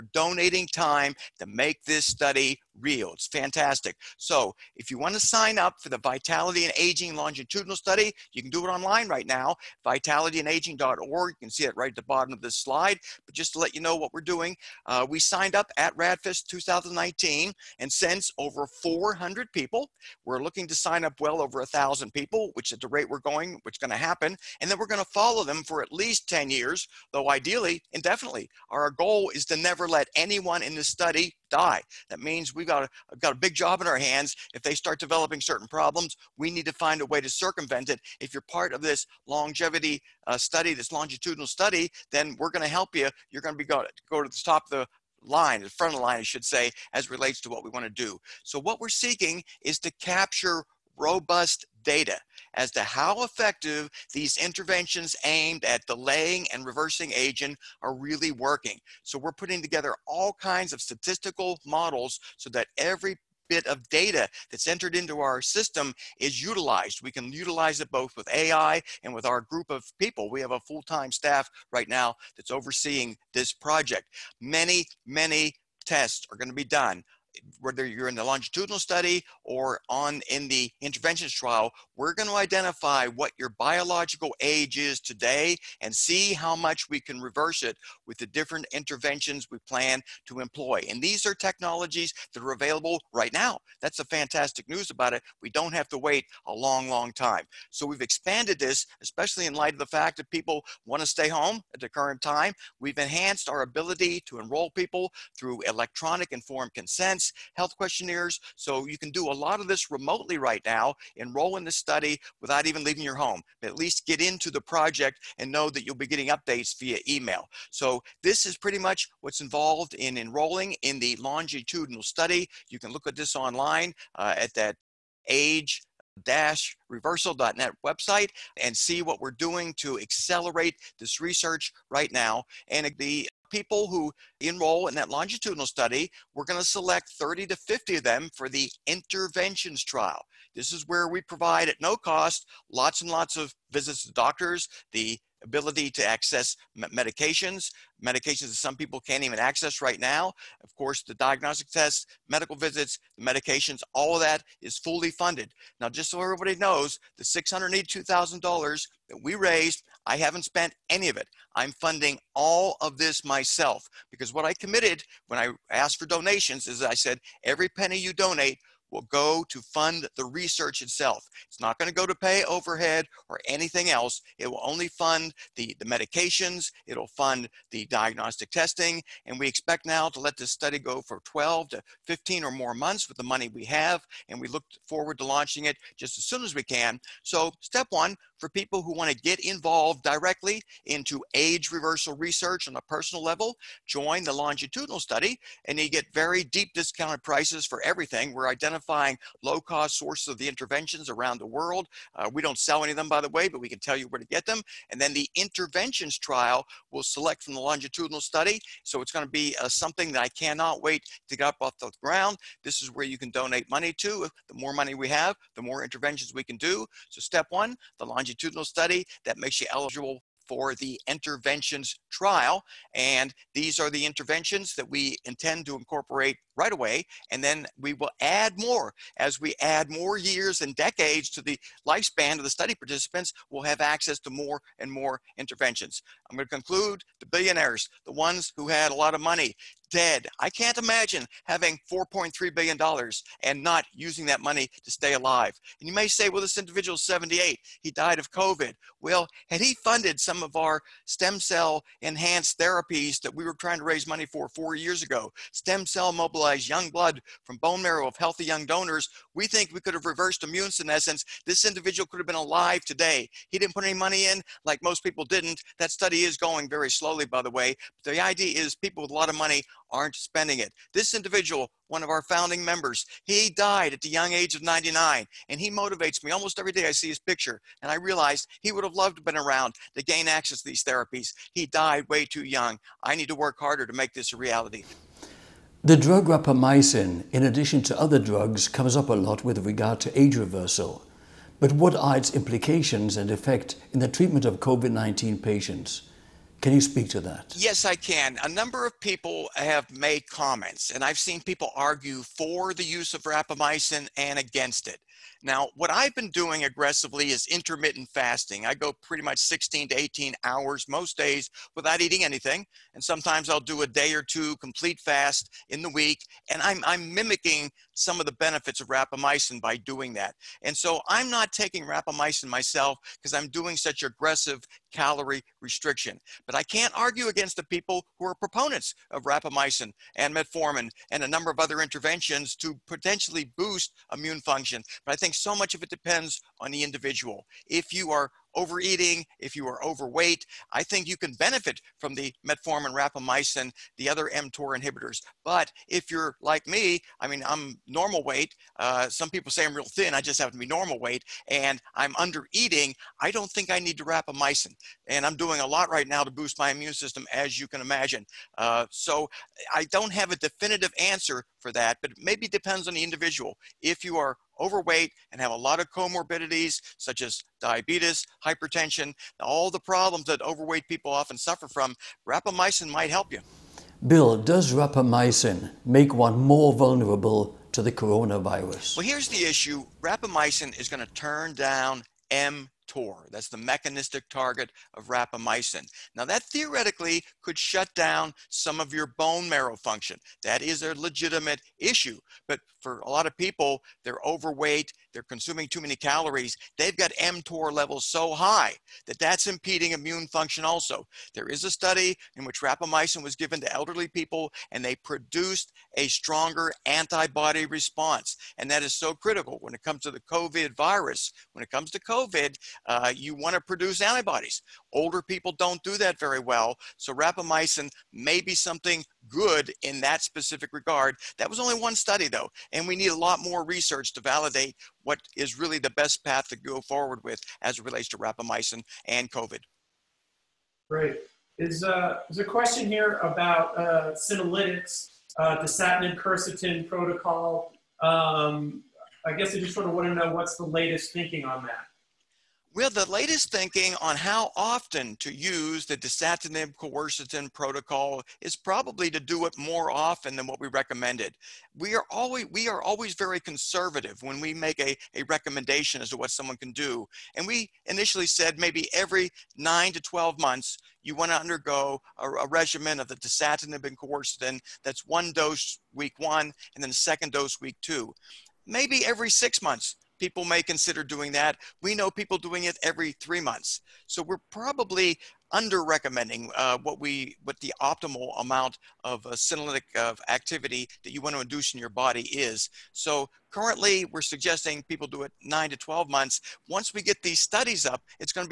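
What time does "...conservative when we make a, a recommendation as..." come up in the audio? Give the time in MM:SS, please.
07:33.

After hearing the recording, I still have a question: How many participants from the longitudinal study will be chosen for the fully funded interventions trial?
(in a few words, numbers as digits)
30 to 50.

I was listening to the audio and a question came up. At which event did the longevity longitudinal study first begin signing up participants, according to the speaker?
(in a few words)
RadFest 2019.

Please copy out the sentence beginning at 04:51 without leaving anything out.
But what are its implications and effect in the treatment of COVID 19 patients?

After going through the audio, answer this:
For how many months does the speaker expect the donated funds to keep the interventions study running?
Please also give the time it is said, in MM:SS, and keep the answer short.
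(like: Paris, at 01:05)
12 to 15, at 03:01.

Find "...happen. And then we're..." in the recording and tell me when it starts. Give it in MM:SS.
00:23.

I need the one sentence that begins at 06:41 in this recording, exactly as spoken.
There is a study in which rapamycin was given to elderly people and they produced a stronger antibody response.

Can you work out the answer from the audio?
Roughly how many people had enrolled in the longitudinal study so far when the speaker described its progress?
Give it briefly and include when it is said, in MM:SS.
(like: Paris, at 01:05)
over 400, at 00:18.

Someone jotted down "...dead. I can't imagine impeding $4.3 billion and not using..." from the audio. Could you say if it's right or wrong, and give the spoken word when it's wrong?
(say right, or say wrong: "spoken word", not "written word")
wrong: "having", not "impeding".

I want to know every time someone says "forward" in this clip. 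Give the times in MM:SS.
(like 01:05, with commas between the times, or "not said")
03:04, 07:06.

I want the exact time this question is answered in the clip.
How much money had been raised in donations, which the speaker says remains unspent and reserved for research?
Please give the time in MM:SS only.
02:37.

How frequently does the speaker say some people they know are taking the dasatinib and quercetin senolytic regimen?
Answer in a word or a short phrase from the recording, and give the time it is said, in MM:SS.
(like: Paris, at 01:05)
every 3 months, at 07:52.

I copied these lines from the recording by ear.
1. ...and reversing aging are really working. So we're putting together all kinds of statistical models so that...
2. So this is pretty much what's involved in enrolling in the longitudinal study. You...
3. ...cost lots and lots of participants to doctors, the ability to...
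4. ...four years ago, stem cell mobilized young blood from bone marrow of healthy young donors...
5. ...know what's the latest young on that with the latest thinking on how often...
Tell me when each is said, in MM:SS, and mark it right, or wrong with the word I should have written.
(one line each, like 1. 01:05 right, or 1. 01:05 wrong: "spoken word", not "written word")
1. 00:56 right
2. 01:57 right
3. 02:21 wrong: "visits", not "participants"
4. 04:14 right
5. 07:20 wrong: "thinking", not "young".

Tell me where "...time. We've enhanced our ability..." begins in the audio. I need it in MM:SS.
01:42.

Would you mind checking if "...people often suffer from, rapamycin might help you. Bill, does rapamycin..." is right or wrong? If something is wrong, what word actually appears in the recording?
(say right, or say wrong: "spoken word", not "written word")
right.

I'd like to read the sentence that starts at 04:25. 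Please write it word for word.
That study is going very slowly, by the way.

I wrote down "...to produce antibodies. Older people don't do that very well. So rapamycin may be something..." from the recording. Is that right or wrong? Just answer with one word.
right.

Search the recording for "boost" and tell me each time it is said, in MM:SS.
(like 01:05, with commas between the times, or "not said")
05:33, 05:56.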